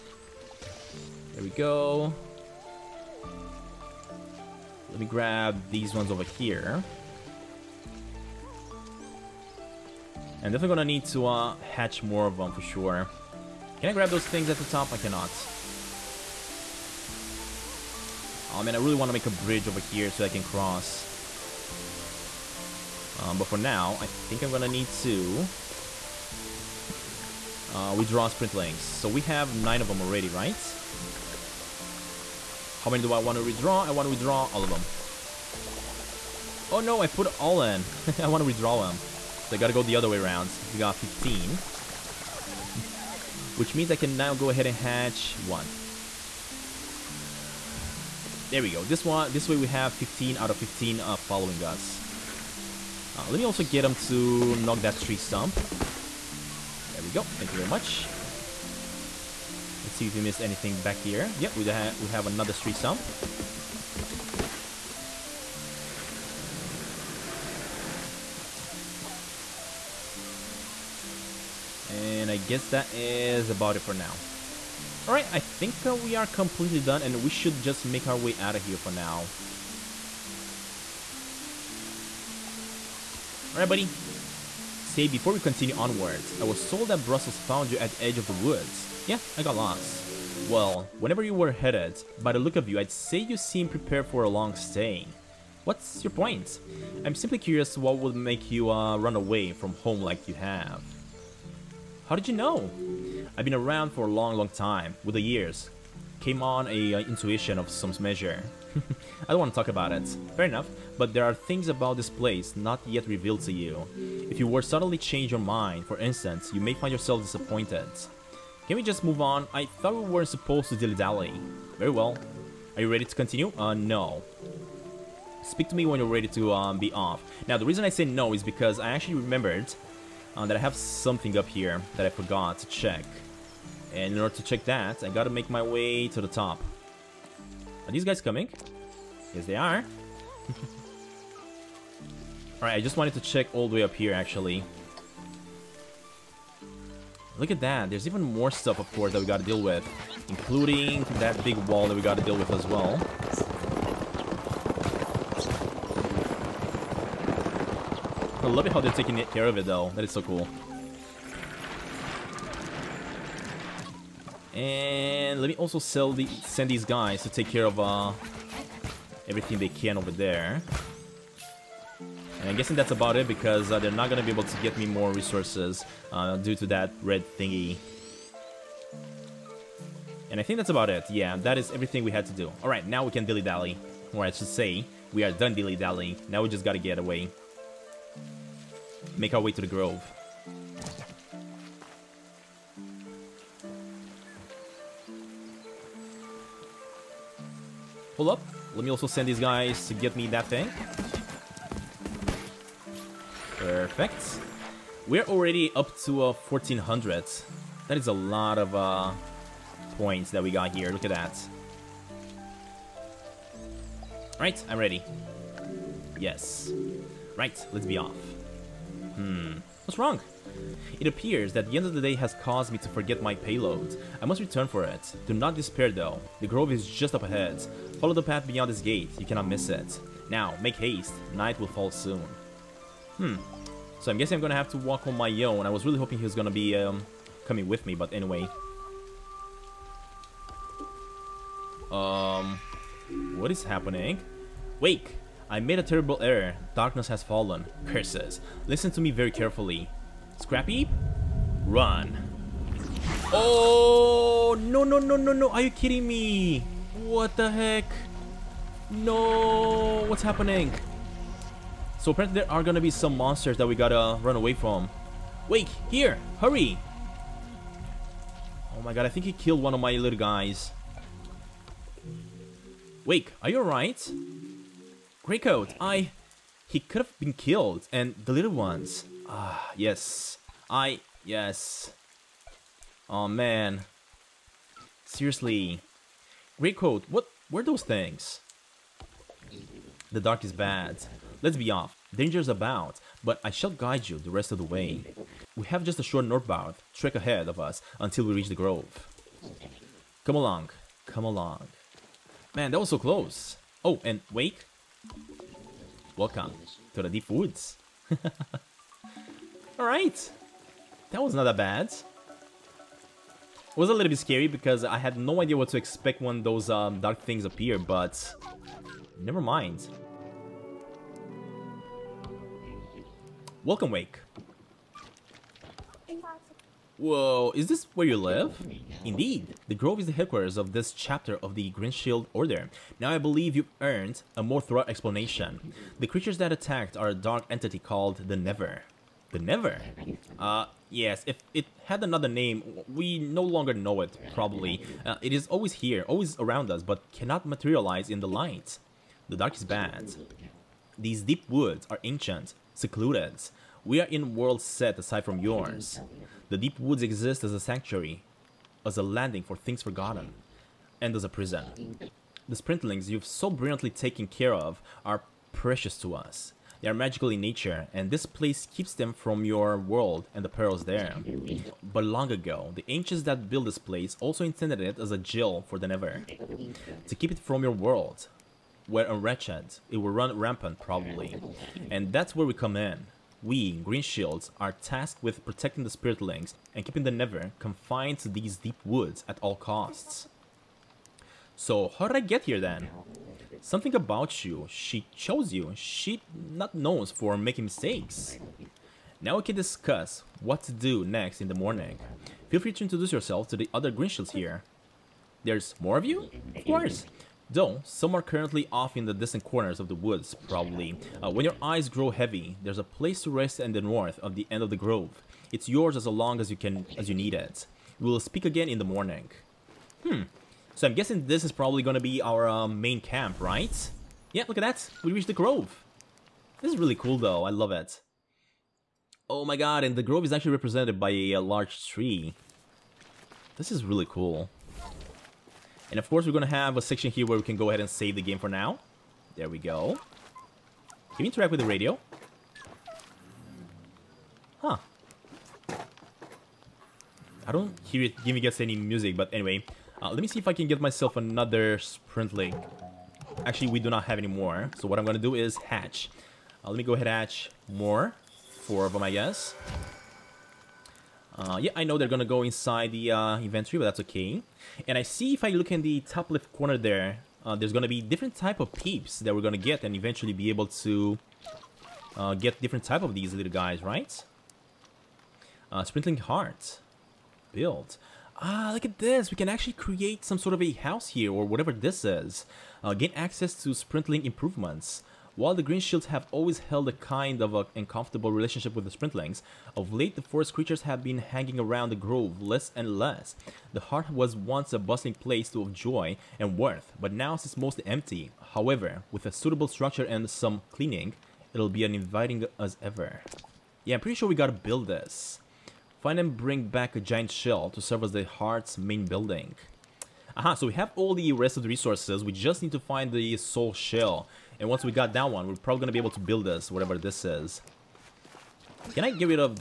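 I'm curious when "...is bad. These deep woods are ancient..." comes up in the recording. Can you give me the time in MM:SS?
05:49.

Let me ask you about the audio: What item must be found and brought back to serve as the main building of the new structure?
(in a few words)
giant shell.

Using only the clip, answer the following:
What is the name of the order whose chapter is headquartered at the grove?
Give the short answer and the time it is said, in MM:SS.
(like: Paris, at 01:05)
Green Shield Order, at 05:31.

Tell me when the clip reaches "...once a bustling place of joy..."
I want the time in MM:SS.
08:14.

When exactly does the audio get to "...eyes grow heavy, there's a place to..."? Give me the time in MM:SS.
06:51.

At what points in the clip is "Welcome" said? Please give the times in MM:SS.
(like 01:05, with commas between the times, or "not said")
05:06, 05:23.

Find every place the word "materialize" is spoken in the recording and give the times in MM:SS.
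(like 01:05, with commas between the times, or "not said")
05:47.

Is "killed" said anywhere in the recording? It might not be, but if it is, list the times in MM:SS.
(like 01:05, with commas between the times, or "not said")
04:29, 04:37.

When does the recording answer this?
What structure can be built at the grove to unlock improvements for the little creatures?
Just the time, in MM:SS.
07:55.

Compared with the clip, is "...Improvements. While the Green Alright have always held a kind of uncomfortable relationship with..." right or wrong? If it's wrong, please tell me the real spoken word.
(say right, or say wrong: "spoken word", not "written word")
wrong: "Shields", not "Alright".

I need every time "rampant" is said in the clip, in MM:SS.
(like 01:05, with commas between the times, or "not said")
06:20.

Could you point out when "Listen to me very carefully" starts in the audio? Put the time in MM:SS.
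04:08.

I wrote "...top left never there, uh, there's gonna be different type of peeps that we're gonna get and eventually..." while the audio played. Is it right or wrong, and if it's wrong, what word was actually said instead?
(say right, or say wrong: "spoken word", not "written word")
wrong: "corner", not "never".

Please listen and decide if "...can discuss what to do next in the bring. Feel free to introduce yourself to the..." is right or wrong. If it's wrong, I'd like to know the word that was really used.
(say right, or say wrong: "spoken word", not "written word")
wrong: "morning", not "bring".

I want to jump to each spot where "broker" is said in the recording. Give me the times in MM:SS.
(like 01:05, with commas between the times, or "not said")
not said.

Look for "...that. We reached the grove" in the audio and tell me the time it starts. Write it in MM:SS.
07:04.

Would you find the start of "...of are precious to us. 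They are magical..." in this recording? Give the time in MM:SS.
06:04.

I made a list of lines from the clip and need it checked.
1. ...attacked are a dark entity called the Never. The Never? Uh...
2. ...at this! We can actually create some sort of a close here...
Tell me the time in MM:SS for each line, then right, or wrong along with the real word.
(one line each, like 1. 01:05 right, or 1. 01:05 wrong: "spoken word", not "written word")
1. 05:36 right
2. 07:58 wrong: "house", not "close".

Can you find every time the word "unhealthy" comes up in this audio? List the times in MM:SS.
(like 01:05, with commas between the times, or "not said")
not said.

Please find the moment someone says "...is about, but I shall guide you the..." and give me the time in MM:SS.
04:52.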